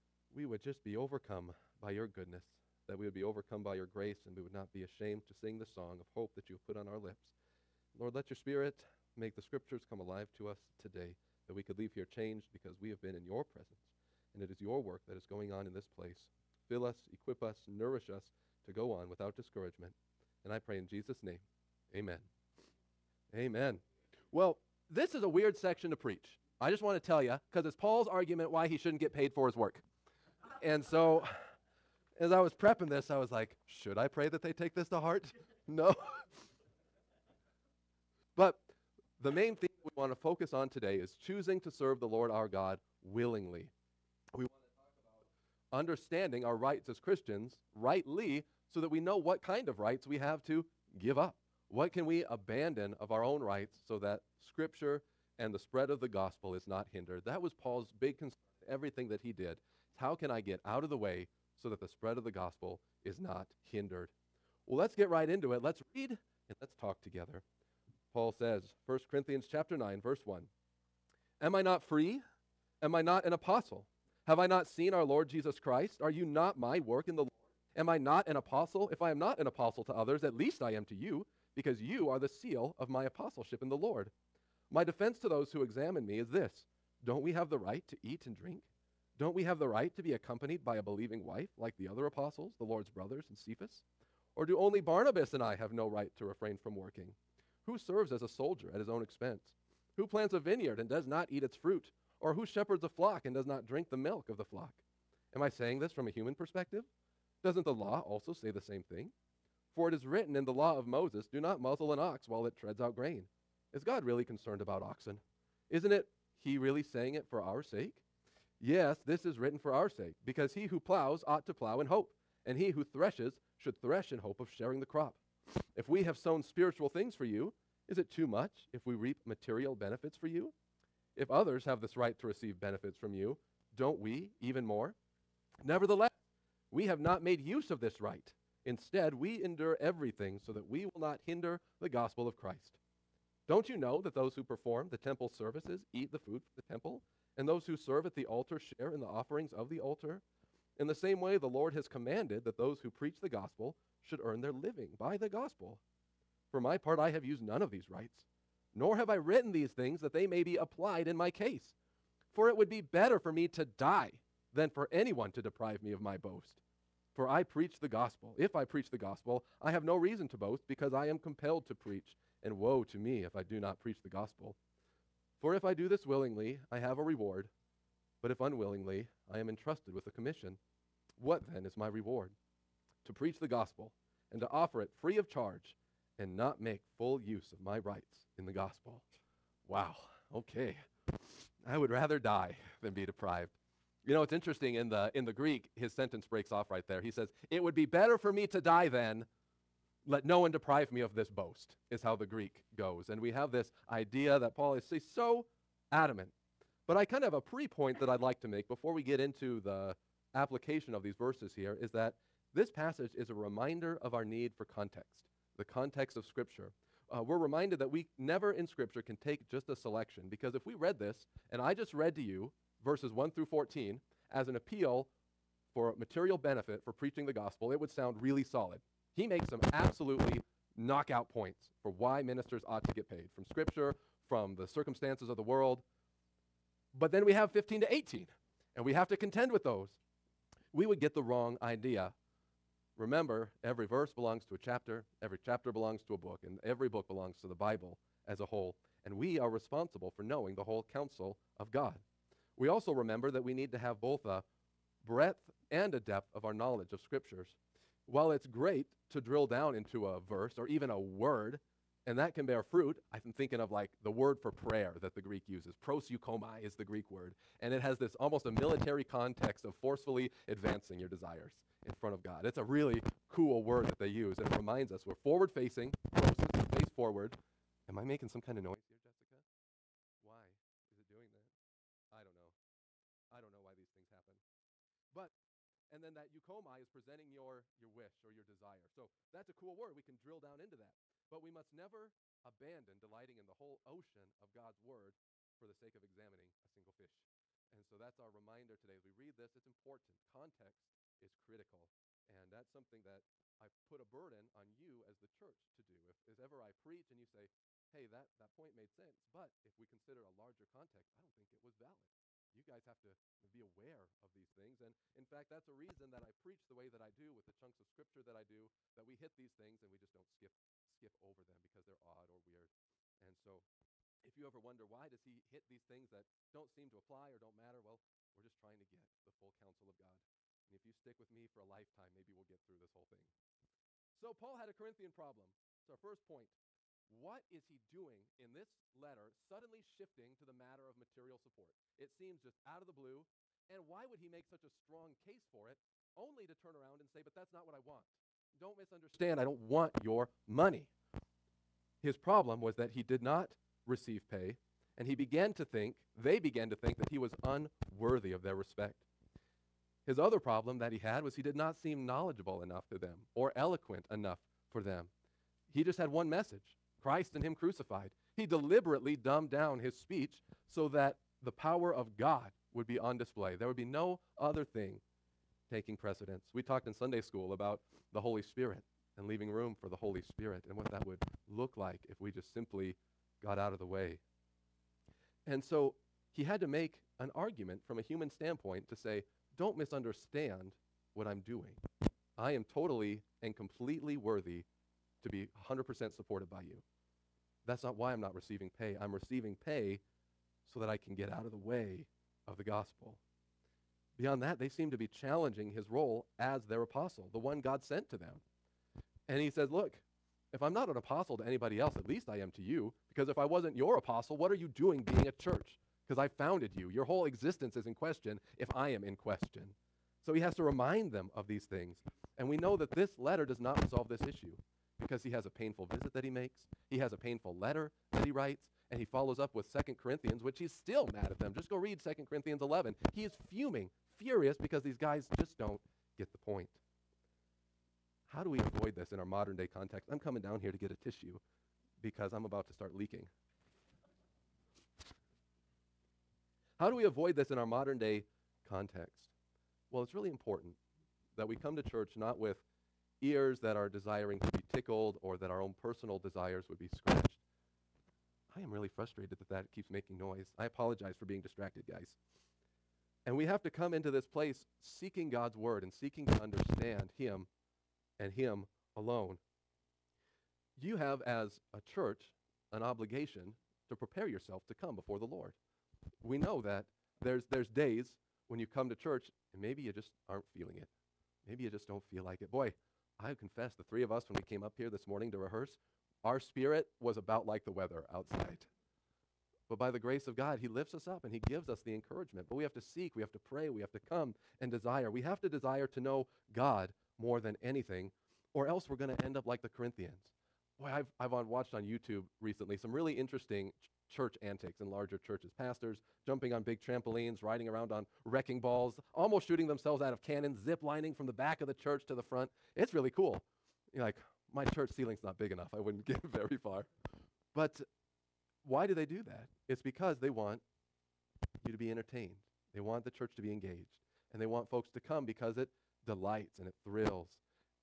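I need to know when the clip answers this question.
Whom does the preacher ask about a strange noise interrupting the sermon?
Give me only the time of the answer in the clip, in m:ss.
4:39.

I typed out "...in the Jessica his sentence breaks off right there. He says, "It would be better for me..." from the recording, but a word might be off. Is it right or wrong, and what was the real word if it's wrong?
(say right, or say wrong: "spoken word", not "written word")
wrong: "Greek", not "Jessica".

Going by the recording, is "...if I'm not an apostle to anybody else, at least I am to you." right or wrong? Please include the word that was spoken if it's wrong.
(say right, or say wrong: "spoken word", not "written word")
right.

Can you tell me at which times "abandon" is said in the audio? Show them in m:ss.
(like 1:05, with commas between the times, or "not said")
0:52, 4:52.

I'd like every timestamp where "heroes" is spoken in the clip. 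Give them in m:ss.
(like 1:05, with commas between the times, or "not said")
not said.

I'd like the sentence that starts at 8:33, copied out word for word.
You're like, my church ceiling's not big enough.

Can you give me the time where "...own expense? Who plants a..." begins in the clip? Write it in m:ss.
1:38.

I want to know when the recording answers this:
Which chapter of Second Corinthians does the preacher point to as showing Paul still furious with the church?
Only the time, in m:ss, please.
7:11.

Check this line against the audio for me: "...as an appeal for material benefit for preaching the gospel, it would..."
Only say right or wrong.
right.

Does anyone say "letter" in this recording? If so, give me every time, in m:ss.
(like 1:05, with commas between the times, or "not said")
5:38, 7:03, 7:07.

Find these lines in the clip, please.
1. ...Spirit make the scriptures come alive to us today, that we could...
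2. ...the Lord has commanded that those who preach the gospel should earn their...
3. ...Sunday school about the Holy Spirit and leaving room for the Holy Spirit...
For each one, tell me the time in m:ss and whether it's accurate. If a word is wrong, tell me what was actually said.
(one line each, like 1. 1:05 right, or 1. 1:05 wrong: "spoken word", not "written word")
1. 0:08 right
2. 2:31 right
3. 6:16 right.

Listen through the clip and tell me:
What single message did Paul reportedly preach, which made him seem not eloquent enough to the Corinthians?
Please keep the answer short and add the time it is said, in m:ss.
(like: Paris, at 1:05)
Christ and Him crucified, at 6:07.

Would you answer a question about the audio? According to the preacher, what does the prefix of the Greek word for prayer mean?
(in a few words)
To face forward.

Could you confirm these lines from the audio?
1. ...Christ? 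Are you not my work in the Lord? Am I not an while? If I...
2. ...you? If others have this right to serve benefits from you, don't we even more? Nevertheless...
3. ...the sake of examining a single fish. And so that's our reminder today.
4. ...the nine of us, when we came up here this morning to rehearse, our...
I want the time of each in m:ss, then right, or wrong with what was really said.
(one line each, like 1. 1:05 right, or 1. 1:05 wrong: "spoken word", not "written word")
1. 1:15 wrong: "apostle", not "while"
2. 2:10 wrong: "receive", not "serve"
3. 4:55 right
4. 8:03 wrong: "three", not "nine".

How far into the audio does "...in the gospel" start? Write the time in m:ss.
3:08.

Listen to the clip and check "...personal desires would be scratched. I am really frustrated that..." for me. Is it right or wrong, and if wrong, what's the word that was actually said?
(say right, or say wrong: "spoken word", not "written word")
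right.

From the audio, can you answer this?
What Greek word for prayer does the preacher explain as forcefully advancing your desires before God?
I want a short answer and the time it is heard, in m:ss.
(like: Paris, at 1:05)
Proseuchomai, at 4:25.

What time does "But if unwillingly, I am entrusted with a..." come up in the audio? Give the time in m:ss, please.
2:58.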